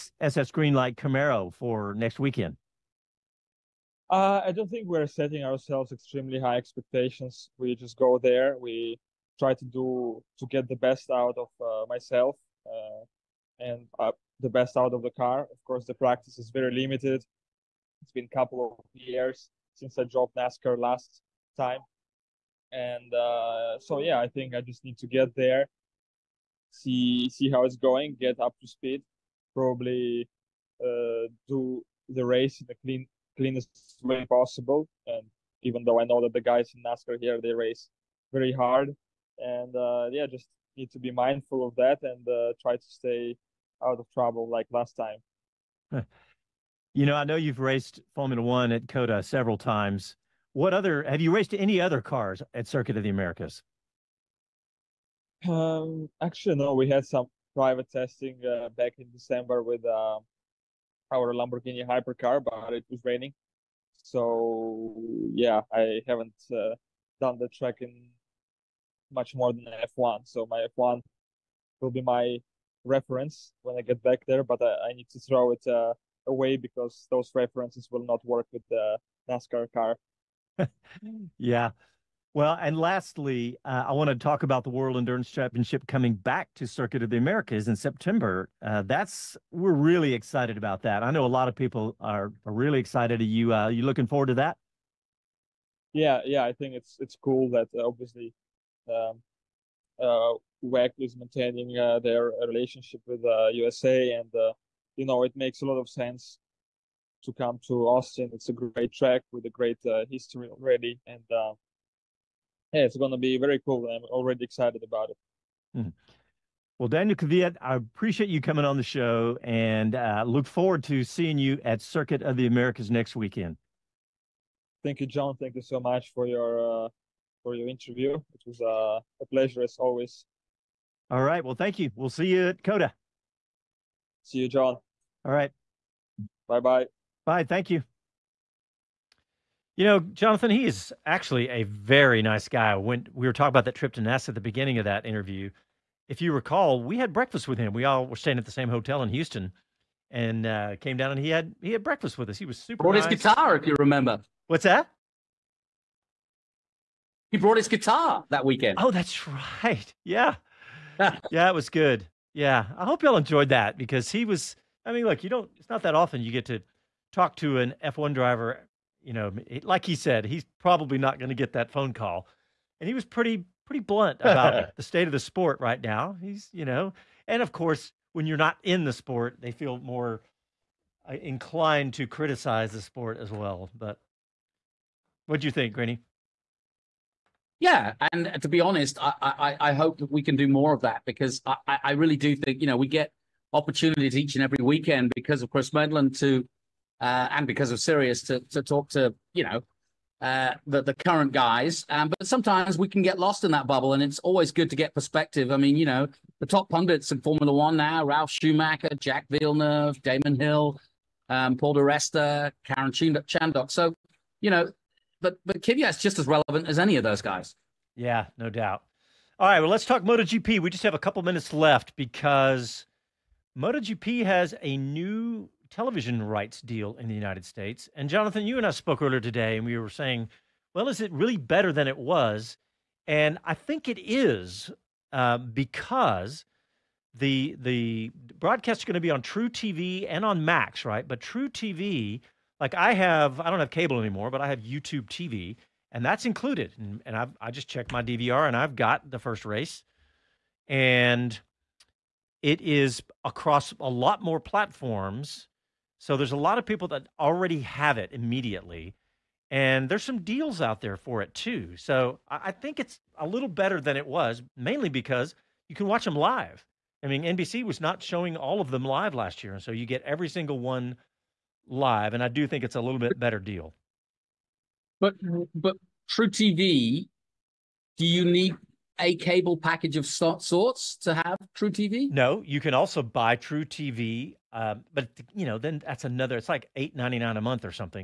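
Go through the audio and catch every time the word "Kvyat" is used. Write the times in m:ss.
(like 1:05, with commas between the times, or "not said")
1:57, 3:35.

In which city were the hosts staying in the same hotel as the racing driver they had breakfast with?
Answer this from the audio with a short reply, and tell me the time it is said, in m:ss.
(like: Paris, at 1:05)
Houston, at 2:29.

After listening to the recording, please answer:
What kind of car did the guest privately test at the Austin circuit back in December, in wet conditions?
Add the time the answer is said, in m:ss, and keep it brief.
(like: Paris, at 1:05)
Lamborghini hypercar, at 1:01.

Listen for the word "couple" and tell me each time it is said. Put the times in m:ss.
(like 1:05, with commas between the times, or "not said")
0:18, 3:40.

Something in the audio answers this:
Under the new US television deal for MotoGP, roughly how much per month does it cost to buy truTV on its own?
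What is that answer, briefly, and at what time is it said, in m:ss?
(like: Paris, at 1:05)
$8.99, at 4:46.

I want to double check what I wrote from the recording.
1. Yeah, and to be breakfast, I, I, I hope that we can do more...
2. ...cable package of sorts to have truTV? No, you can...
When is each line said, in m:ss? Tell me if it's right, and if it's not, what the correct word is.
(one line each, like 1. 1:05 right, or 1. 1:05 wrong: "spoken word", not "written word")
1. 3:07 wrong: "honest", not "breakfast"
2. 4:39 right.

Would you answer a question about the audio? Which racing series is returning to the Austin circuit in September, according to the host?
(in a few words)
World Endurance Championship.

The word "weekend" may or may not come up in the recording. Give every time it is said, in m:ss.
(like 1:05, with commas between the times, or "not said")
0:02, 2:03, 2:38, 3:14.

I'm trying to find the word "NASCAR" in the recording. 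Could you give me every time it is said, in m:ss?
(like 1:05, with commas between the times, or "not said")
0:20, 0:36, 1:19.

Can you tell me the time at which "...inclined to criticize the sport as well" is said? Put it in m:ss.
3:01.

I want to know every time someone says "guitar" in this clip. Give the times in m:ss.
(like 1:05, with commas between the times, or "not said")
2:33, 2:37.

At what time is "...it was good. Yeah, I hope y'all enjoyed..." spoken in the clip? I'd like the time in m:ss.
2:41.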